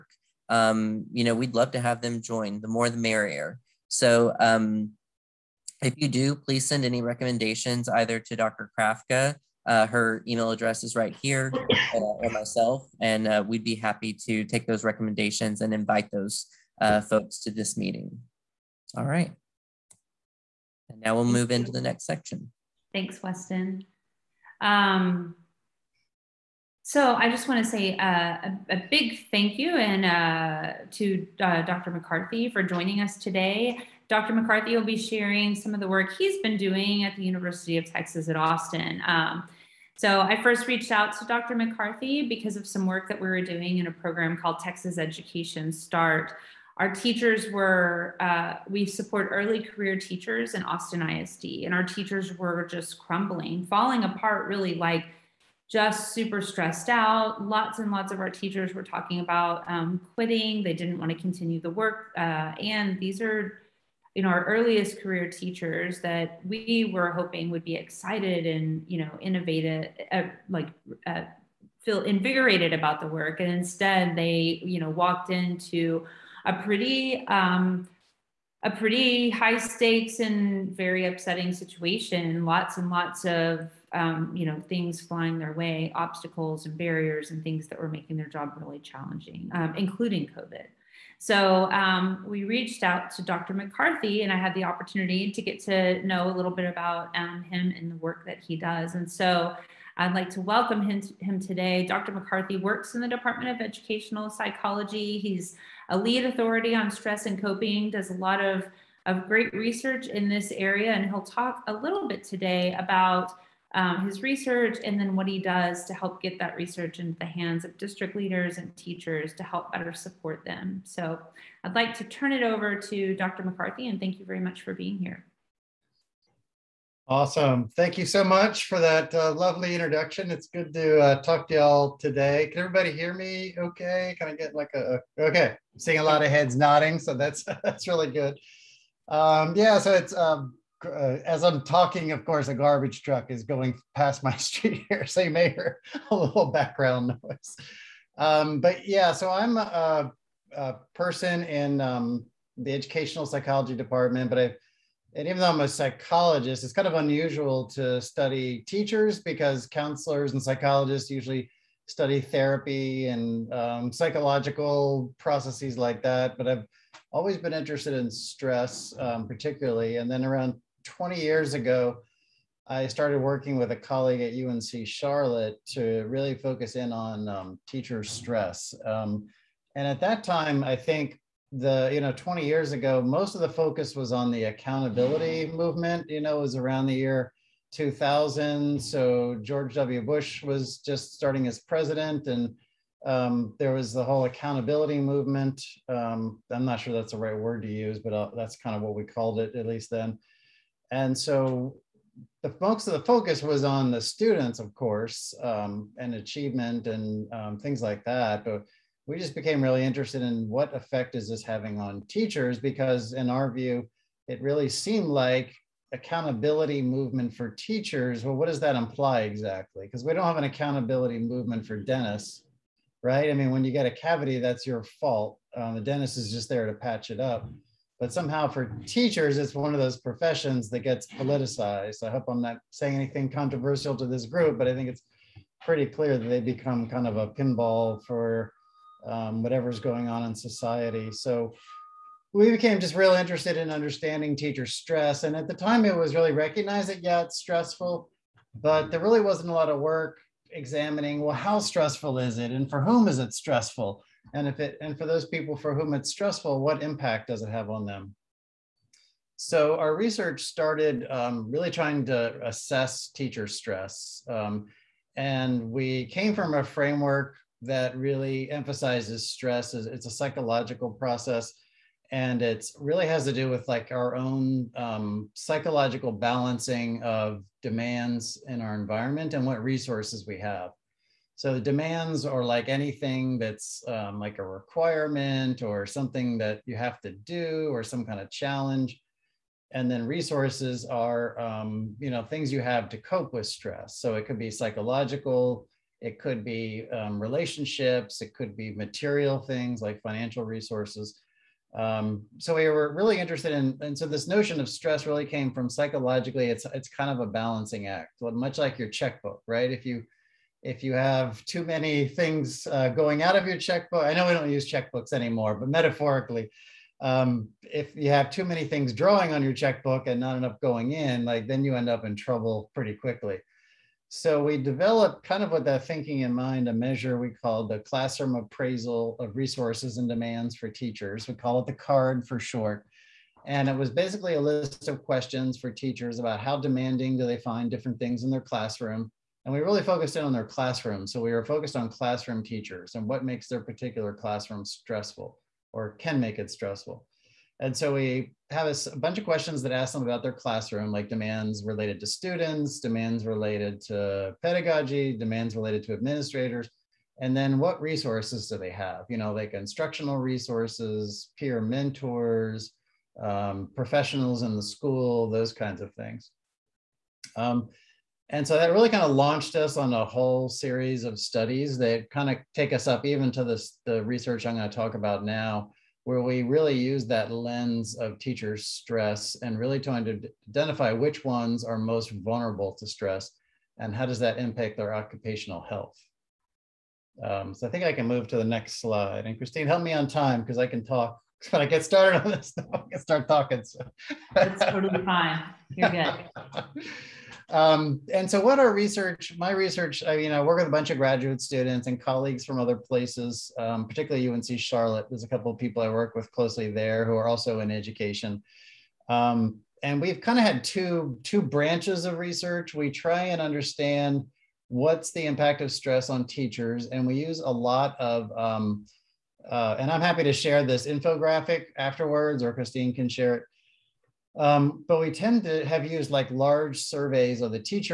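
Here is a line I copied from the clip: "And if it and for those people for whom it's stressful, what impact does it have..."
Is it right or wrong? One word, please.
right.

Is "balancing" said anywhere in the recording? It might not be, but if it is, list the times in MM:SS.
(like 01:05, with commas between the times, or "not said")
04:36, 05:07.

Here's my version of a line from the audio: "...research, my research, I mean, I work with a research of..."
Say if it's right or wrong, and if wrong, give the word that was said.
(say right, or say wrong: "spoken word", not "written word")
wrong: "bunch", not "research".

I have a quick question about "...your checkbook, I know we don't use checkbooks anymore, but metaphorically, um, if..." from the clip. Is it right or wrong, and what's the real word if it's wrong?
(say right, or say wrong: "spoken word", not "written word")
right.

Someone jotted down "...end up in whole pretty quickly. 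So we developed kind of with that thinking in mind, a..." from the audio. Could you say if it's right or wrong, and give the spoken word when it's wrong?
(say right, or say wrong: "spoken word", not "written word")
wrong: "trouble", not "whole".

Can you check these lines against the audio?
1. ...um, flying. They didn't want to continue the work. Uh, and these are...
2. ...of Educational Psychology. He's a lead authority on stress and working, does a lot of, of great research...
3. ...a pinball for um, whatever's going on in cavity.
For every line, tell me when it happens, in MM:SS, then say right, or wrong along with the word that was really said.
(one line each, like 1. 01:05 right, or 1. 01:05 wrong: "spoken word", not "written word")
1. 00:59 wrong: "quitting", not "flying"
2. 01:43 wrong: "coping", not "working"
3. 03:57 wrong: "society", not "cavity".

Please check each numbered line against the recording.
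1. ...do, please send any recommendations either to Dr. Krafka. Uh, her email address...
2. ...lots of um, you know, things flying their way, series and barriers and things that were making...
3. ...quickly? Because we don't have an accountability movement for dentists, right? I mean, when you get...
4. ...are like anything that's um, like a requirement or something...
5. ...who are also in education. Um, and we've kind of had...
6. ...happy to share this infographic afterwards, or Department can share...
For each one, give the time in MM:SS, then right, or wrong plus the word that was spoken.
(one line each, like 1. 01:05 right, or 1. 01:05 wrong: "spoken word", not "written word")
1. 00:06 right
2. 01:22 wrong: "obstacles", not "series"
3. 03:39 wrong: "exactly", not "quickly"
4. 04:42 right
5. 06:47 right
6. 07:00 wrong: "Christine", not "Department".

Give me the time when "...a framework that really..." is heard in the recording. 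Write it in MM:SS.
04:26.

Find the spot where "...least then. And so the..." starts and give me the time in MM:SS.
03:19.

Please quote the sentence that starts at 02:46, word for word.
But I've always been interested in stress, um, particularly.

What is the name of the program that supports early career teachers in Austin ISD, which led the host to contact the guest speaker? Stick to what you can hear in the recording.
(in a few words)
Texas Education Start.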